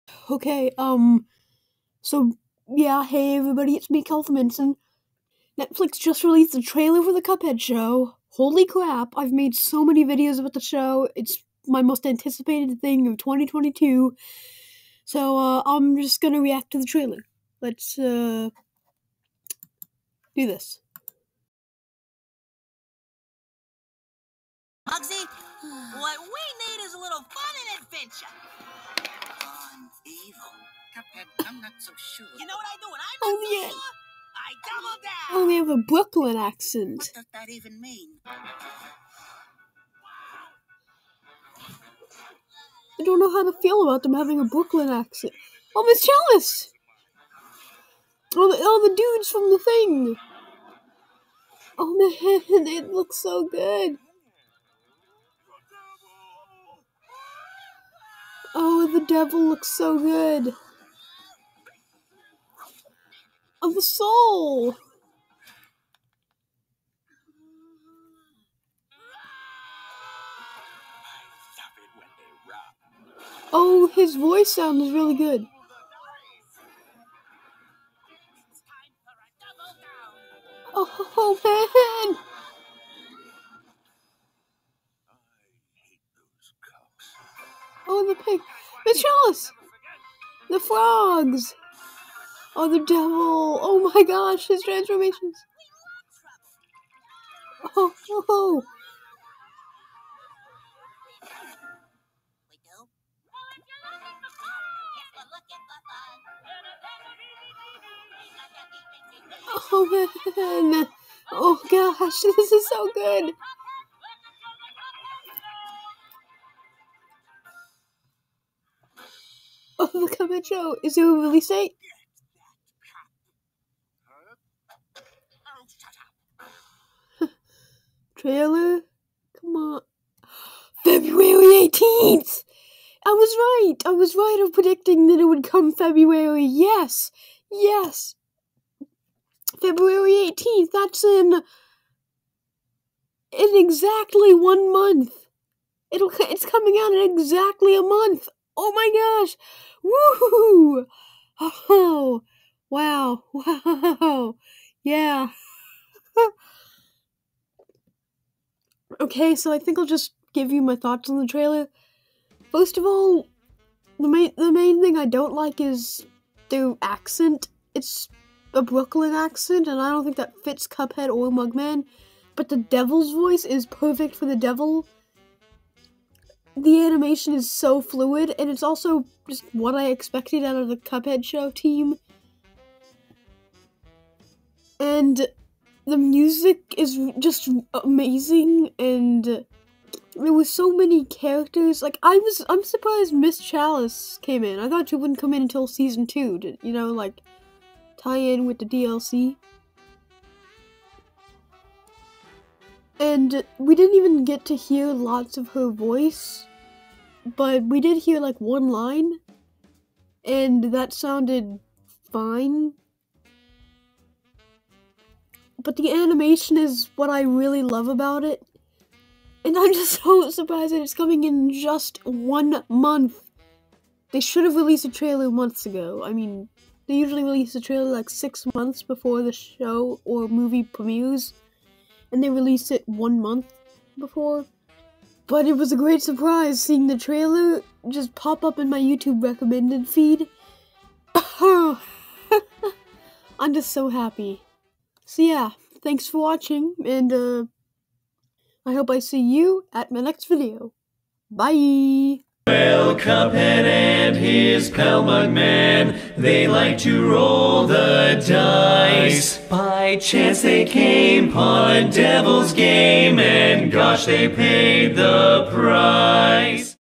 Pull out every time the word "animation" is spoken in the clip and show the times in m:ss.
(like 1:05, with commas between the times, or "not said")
2:56, 3:35.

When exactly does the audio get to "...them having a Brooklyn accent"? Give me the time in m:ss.
0:44.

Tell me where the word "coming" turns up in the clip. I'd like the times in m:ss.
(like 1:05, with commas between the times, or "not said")
2:00, 2:26, 3:40.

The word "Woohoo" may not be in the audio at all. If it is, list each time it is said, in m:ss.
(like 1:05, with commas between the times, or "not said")
2:29.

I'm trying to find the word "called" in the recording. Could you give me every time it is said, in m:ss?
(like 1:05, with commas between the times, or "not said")
not said.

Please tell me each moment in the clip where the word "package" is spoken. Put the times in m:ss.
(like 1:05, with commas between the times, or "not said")
not said.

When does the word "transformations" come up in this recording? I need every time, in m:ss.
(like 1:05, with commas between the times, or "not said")
1:34.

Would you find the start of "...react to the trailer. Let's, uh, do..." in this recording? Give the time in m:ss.
0:16.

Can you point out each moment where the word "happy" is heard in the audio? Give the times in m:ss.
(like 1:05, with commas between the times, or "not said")
4:03.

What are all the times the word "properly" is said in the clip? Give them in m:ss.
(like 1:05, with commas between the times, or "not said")
not said.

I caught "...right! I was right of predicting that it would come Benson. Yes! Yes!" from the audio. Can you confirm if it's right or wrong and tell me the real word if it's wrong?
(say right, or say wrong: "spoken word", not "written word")
wrong: "February", not "Benson".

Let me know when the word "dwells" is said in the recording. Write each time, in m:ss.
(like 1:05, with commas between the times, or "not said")
not said.